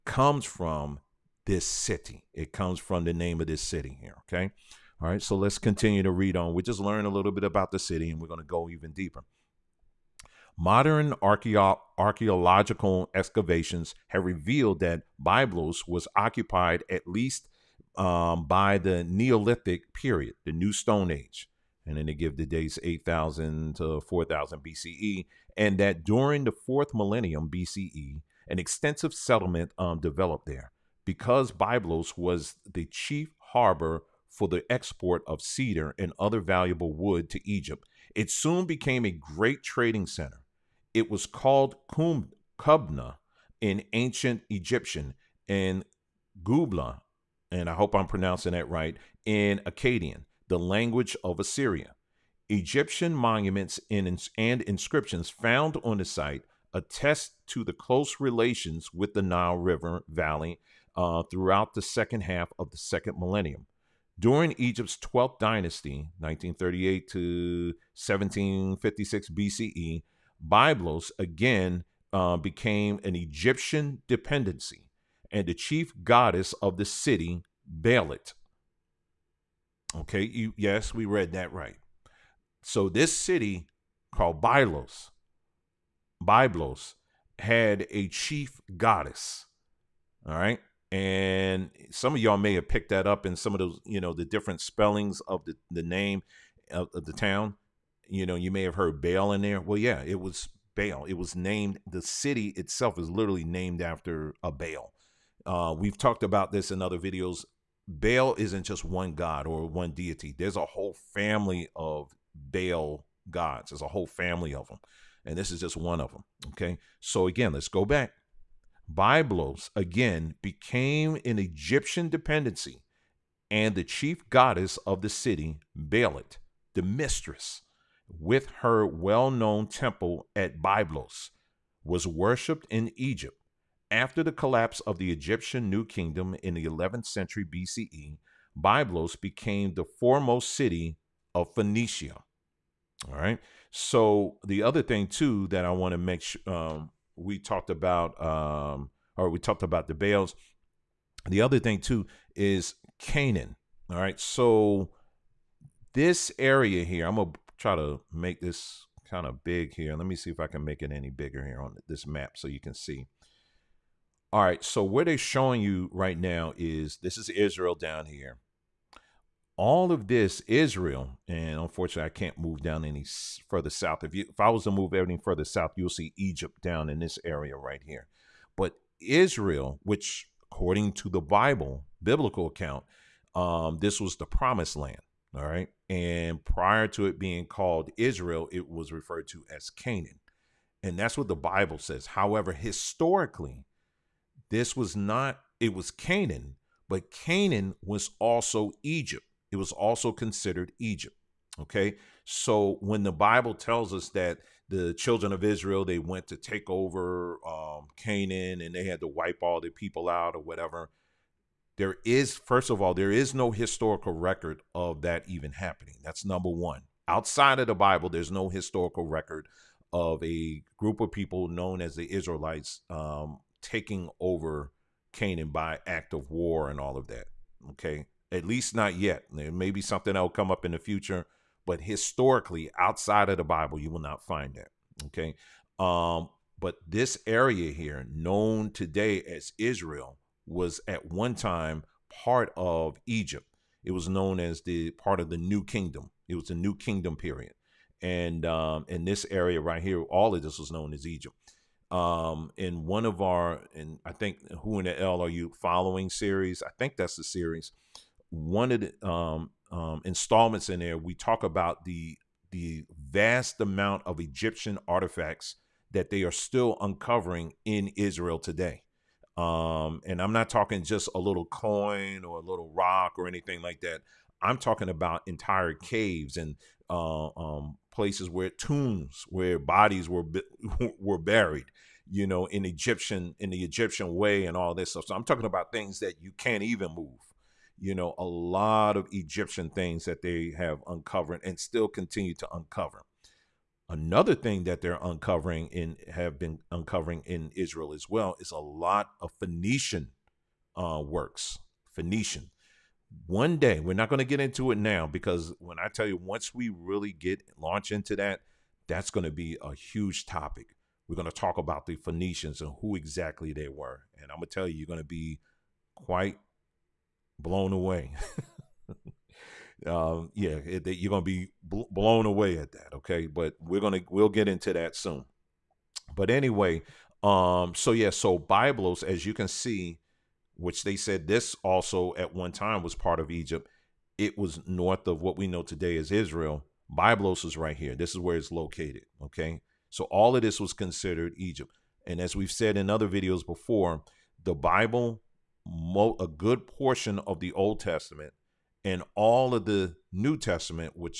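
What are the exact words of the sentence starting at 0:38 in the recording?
It soon became a great trading center.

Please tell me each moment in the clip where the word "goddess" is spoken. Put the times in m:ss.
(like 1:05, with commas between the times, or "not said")
1:16, 1:28, 2:04.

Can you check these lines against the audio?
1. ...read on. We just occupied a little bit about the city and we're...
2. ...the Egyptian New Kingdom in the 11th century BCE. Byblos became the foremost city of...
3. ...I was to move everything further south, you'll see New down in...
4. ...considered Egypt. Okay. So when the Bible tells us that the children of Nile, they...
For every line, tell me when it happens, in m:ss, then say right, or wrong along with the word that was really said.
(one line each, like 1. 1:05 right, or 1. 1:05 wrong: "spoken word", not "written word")
1. 0:06 wrong: "learned", not "occupied"
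2. 2:14 right
3. 2:54 wrong: "Egypt", not "New"
4. 3:20 wrong: "Israel", not "Nile".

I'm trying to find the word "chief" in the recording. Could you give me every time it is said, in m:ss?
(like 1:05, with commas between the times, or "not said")
0:32, 1:15, 1:28, 2:03.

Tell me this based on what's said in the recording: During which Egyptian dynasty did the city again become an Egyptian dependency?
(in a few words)
12th dynasty.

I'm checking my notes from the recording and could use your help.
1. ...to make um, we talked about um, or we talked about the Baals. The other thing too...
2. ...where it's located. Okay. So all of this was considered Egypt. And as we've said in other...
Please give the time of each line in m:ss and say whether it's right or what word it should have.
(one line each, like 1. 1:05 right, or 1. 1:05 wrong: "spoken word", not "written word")
1. 2:25 right
2. 5:38 right.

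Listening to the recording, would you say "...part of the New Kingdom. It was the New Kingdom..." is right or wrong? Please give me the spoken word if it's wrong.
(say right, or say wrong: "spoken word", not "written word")
right.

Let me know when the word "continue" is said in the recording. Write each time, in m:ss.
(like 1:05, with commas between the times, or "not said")
0:05, 4:51.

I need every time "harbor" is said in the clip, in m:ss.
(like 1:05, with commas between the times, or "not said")
0:33.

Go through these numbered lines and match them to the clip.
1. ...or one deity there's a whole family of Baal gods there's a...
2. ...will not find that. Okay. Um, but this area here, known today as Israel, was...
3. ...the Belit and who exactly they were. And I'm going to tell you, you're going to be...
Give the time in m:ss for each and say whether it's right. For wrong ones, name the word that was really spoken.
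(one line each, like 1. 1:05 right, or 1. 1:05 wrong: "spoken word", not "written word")
1. 1:49 right
2. 3:53 right
3. 5:11 wrong: "Phoenicians", not "Belit".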